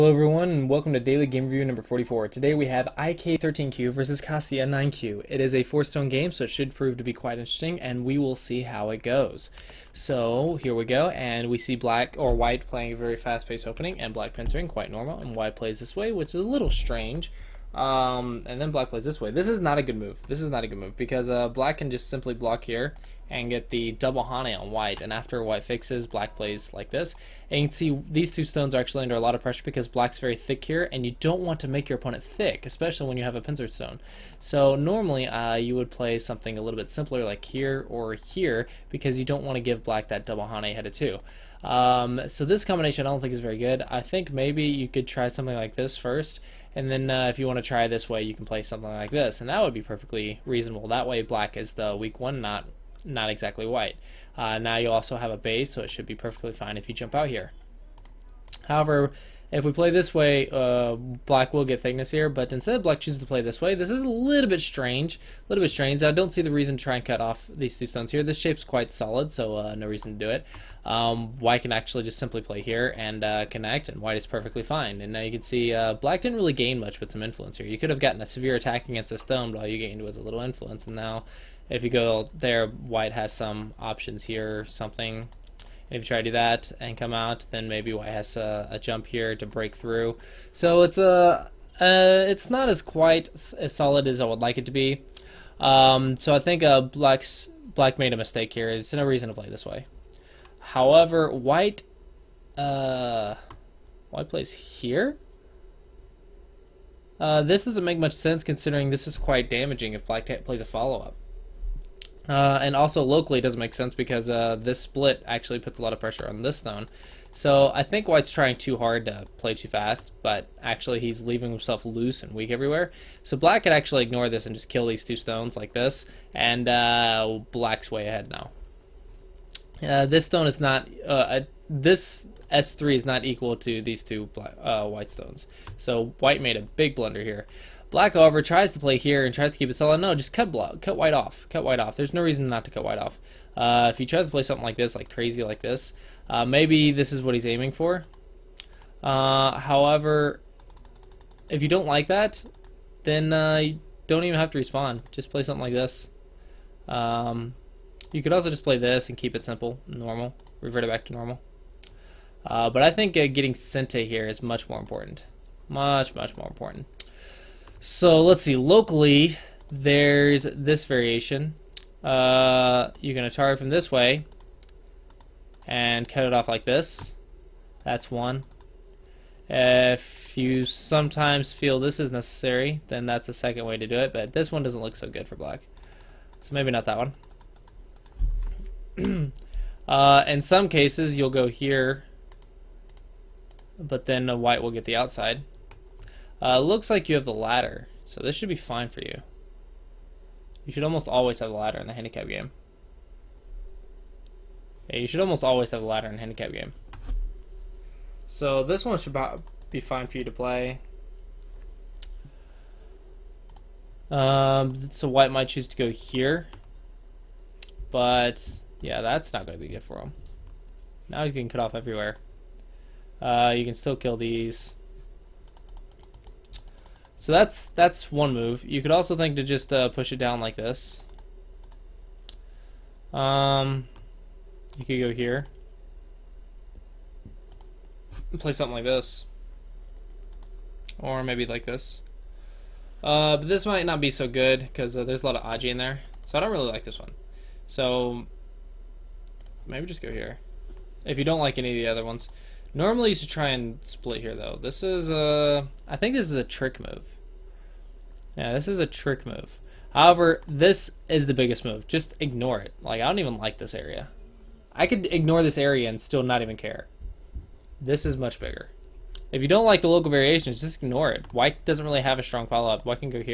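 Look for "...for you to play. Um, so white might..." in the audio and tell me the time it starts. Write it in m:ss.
3:30.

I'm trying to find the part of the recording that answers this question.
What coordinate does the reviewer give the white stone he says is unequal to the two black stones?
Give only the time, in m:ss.
2:12.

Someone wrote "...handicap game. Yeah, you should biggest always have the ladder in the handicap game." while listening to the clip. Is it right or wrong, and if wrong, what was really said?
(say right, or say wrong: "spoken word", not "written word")
wrong: "almost", not "biggest".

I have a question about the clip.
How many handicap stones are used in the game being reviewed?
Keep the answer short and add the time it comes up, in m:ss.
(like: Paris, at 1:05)
4, at 0:05.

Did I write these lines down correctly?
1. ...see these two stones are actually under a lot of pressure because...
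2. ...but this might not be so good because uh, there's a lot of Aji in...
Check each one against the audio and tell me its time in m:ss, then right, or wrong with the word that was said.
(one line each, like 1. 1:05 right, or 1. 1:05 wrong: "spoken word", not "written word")
1. 0:27 right
2. 4:03 right.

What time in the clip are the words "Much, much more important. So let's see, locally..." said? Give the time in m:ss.
2:45.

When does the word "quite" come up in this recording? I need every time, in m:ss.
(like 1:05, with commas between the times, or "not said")
0:07, 0:14, 1:08, 1:32, 1:49.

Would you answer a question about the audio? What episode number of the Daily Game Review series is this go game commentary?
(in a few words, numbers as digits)
44.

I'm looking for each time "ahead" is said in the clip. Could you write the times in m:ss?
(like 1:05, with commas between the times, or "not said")
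2:08.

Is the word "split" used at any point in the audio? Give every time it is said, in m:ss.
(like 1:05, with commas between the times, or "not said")
1:54, 4:13.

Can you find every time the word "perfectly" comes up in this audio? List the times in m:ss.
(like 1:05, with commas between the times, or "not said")
0:49, 0:56, 1:14.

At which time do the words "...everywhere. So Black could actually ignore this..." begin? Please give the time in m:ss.
2:02.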